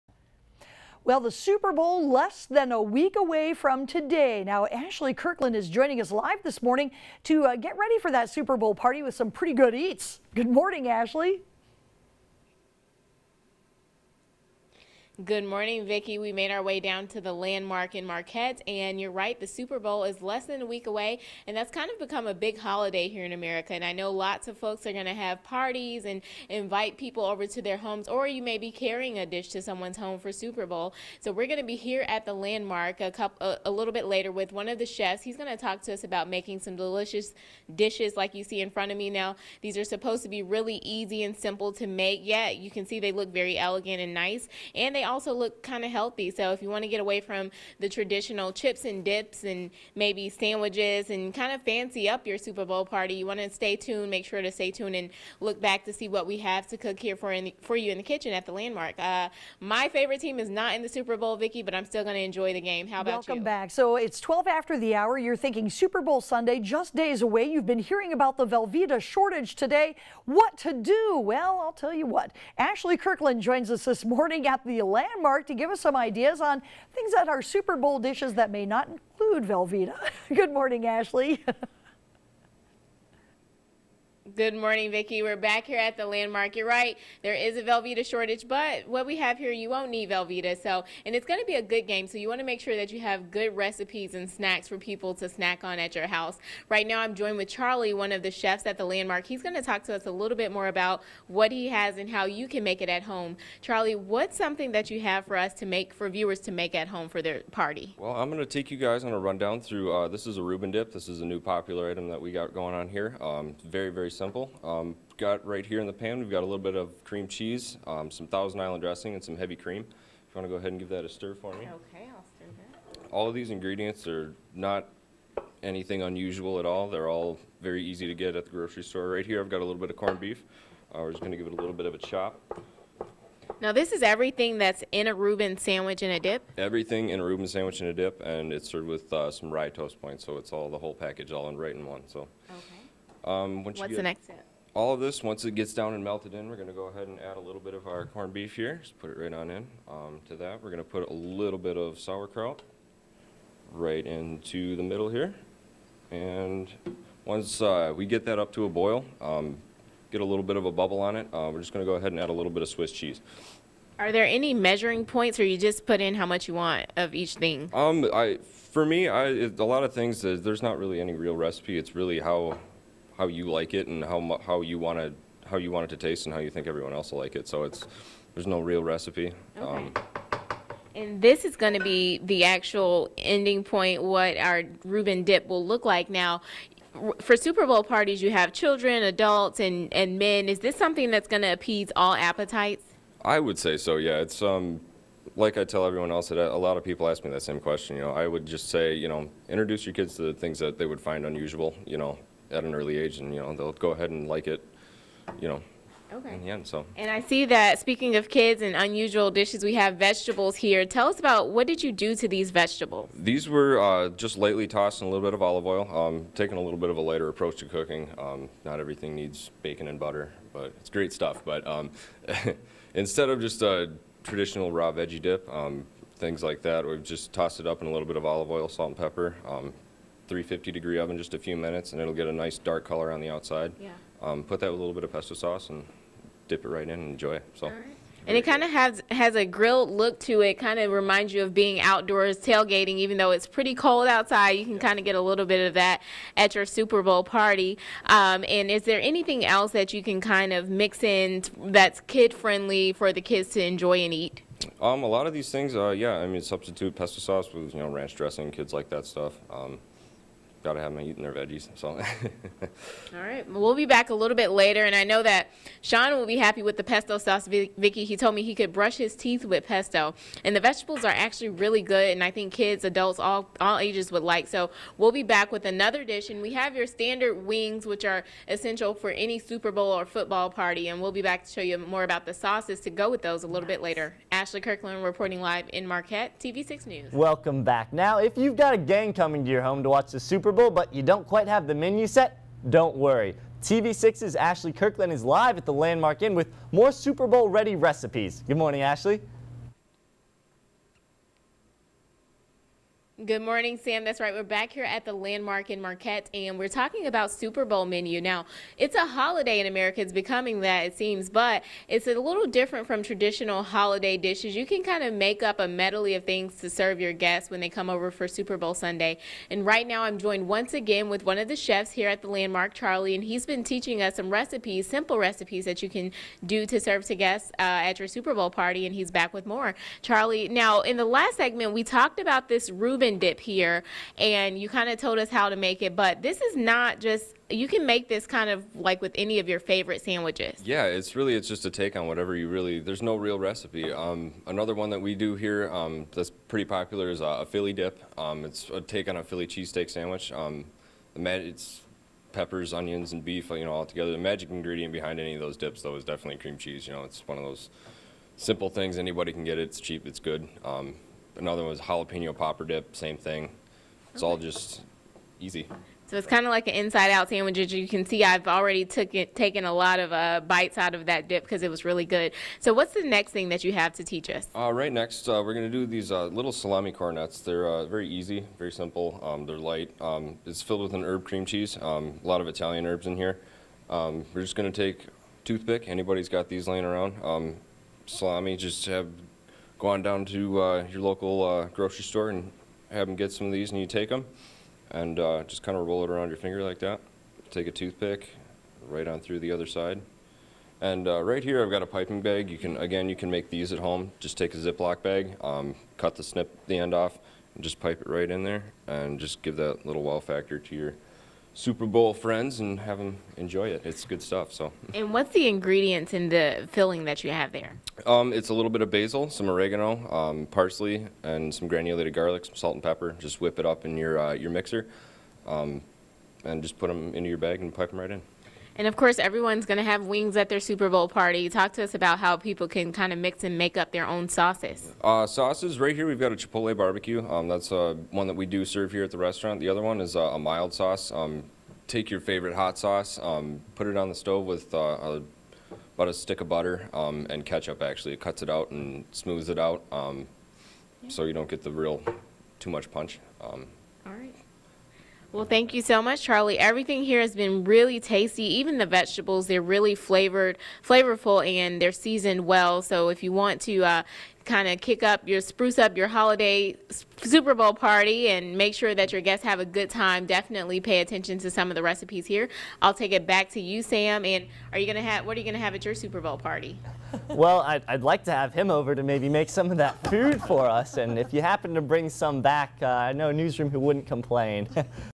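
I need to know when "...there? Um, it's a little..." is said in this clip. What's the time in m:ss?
6:57.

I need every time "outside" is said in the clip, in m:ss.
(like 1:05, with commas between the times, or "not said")
3:53, 4:04.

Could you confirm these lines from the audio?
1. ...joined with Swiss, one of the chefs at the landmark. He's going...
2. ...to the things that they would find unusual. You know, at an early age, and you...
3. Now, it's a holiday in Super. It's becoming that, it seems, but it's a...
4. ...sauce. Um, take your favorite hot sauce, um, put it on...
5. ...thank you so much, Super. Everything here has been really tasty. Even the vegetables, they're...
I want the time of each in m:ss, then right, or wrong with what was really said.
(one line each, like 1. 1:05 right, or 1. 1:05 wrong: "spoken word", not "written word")
1. 1:37 wrong: "Charlie", not "Swiss"
2. 3:20 right
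3. 5:08 wrong: "America", not "Super"
4. 7:20 right
5. 7:35 wrong: "Charlie", not "Super".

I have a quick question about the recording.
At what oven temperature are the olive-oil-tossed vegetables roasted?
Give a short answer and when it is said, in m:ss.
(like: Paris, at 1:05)
350 degrees, at 3:50.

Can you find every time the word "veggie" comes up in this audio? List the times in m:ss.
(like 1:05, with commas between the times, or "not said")
3:44, 4:21.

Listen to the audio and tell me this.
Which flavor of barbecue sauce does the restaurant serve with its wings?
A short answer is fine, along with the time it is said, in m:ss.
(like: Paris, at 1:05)
Chipotle, at 7:16.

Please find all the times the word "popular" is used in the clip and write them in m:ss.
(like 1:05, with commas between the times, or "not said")
1:51, 5:46.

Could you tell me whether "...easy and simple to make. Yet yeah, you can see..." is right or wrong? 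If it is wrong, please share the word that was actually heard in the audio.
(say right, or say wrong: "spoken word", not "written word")
right.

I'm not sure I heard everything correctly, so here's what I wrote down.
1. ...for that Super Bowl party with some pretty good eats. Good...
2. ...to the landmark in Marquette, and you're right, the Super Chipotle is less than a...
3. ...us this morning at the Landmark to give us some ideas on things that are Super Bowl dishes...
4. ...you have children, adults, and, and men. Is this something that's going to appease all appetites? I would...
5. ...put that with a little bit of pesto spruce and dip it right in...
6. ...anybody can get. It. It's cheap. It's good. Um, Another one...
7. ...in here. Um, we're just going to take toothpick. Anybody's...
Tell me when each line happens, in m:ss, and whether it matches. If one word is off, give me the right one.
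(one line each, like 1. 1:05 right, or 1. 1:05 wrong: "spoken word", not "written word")
1. 0:07 right
2. 0:17 wrong: "Bowl", not "Chipotle"
3. 1:13 right
4. 3:08 right
5. 3:54 wrong: "sauce", not "spruce"
6. 5:58 right
7. 6:23 right.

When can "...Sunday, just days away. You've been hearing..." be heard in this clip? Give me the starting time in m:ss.
1:06.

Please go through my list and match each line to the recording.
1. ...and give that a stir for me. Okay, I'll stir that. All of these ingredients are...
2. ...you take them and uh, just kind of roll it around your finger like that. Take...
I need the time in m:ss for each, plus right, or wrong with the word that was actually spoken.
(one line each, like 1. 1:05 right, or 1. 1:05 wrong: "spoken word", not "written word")
1. 2:00 right
2. 6:33 right.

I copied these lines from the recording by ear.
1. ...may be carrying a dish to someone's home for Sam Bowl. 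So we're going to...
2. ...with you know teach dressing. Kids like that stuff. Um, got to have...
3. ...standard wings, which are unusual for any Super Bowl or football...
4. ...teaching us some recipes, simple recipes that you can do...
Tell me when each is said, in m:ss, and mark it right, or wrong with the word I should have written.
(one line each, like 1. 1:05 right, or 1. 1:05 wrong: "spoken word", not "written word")
1. 0:28 wrong: "Super", not "Sam"
2. 4:17 wrong: "ranch", not "teach"
3. 4:36 wrong: "essential", not "unusual"
4. 5:23 right.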